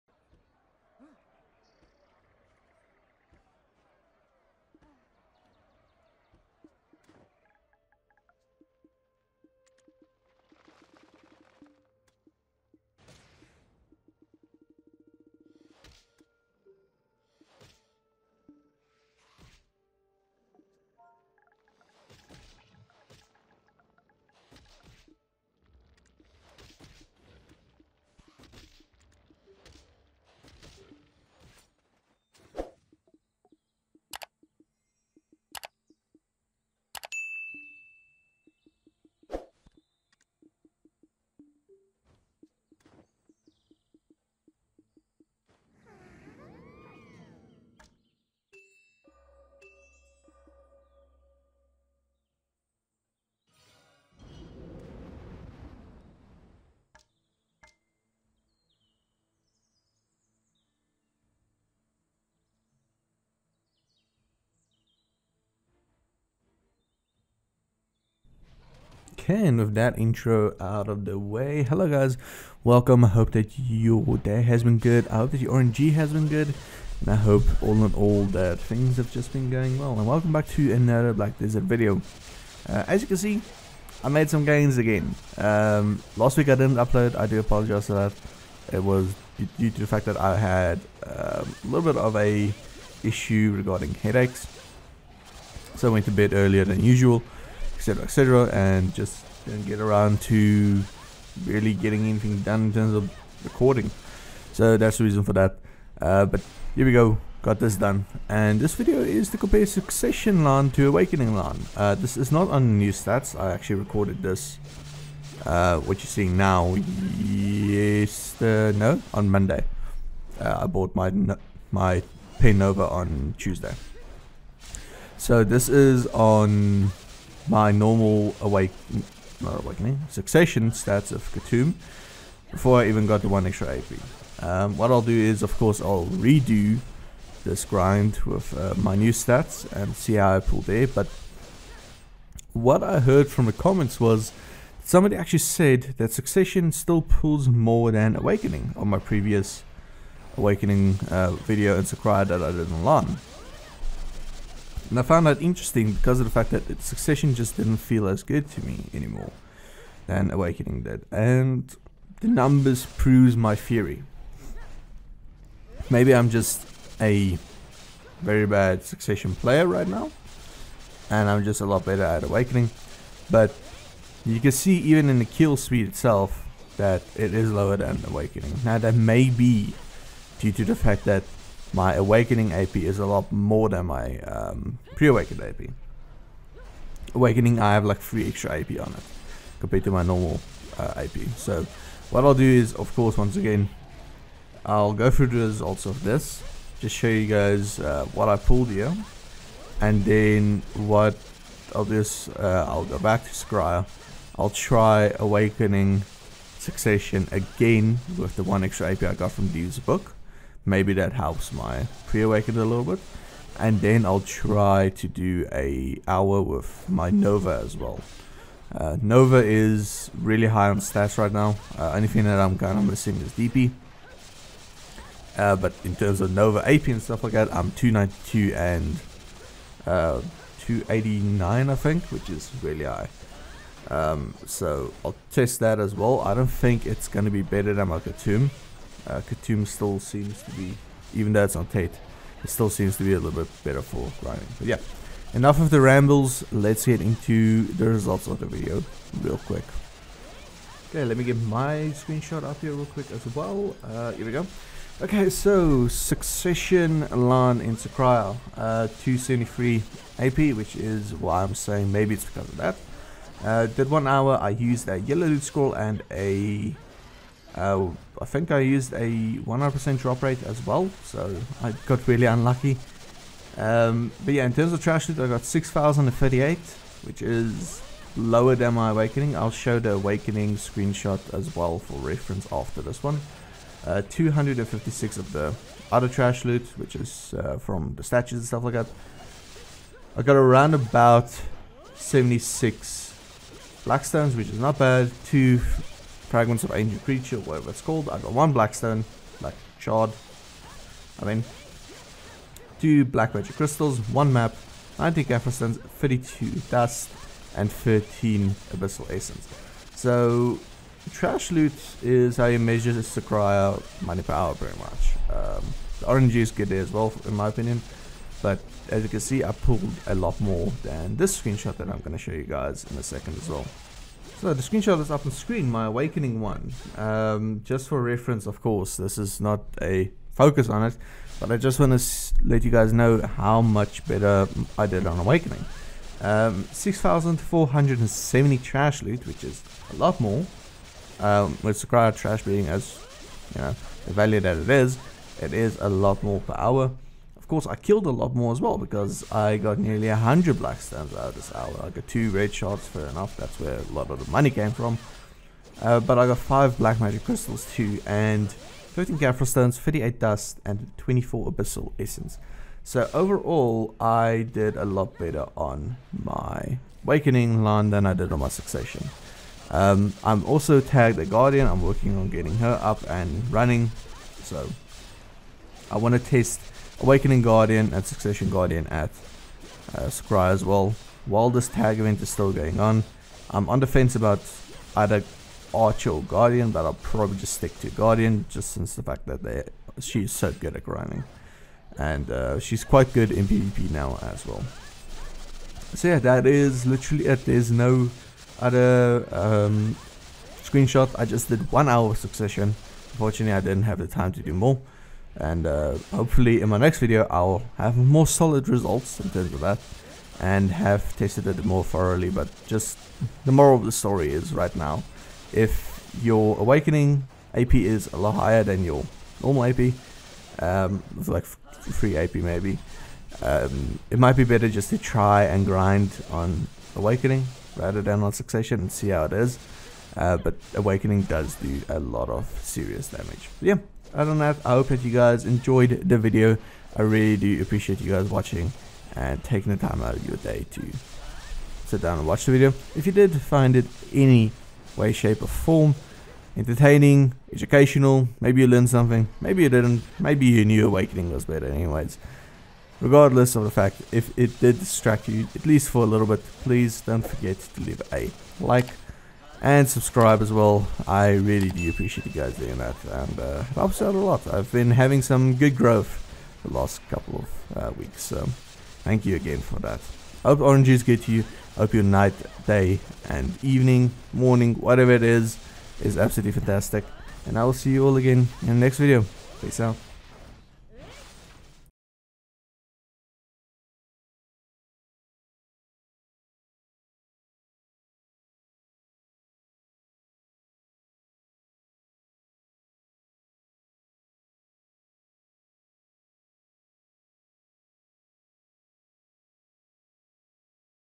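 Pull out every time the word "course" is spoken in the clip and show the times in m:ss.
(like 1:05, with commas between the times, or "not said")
2:15, 3:12, 5:28, 5:47.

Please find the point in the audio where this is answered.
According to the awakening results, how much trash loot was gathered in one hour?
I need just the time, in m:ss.
5:36.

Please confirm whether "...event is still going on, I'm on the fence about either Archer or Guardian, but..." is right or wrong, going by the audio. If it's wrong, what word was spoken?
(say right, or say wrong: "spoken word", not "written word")
right.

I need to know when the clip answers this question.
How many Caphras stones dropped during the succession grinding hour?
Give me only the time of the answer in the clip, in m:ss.
5:04.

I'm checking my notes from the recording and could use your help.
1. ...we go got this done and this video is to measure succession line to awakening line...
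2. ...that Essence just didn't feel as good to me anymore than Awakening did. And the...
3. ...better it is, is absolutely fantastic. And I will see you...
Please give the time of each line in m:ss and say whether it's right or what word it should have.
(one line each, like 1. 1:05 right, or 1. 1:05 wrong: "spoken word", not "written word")
1. 1:46 wrong: "compare", not "measure"
2. 2:36 wrong: "Succession", not "Essence"
3. 7:54 wrong: "whatever", not "better".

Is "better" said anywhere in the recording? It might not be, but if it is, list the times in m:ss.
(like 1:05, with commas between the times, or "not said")
2:51, 3:57, 4:03, 5:34, 6:05, 7:04, 7:31.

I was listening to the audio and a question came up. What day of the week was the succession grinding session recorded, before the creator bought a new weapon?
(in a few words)
Monday.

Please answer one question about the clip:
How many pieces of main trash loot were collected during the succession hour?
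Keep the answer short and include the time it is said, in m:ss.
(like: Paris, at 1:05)
6,038, at 4:35.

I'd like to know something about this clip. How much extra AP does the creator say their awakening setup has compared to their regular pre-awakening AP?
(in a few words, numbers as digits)
3.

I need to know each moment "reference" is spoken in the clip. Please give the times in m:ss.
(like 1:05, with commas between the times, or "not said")
4:42, 5:28.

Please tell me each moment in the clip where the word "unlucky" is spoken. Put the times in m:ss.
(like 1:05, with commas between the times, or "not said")
4:32.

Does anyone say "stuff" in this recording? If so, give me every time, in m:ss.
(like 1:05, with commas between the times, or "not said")
3:47, 4:48.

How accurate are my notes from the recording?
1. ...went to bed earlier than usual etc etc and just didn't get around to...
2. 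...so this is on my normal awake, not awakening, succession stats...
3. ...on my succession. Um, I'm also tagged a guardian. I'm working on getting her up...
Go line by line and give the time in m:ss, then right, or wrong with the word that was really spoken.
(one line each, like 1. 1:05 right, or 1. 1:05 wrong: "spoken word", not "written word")
1. 1:35 right
2. 2:05 right
3. 6:08 right.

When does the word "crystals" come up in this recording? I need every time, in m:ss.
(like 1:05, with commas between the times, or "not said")
5:03, 5:57.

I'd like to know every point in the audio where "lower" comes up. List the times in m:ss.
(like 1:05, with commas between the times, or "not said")
2:57, 4:38.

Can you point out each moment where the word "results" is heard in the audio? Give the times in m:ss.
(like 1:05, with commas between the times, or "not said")
3:15, 4:07, 6:48.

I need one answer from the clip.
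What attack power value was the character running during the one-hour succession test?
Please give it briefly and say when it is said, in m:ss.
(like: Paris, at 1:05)
273, at 4:19.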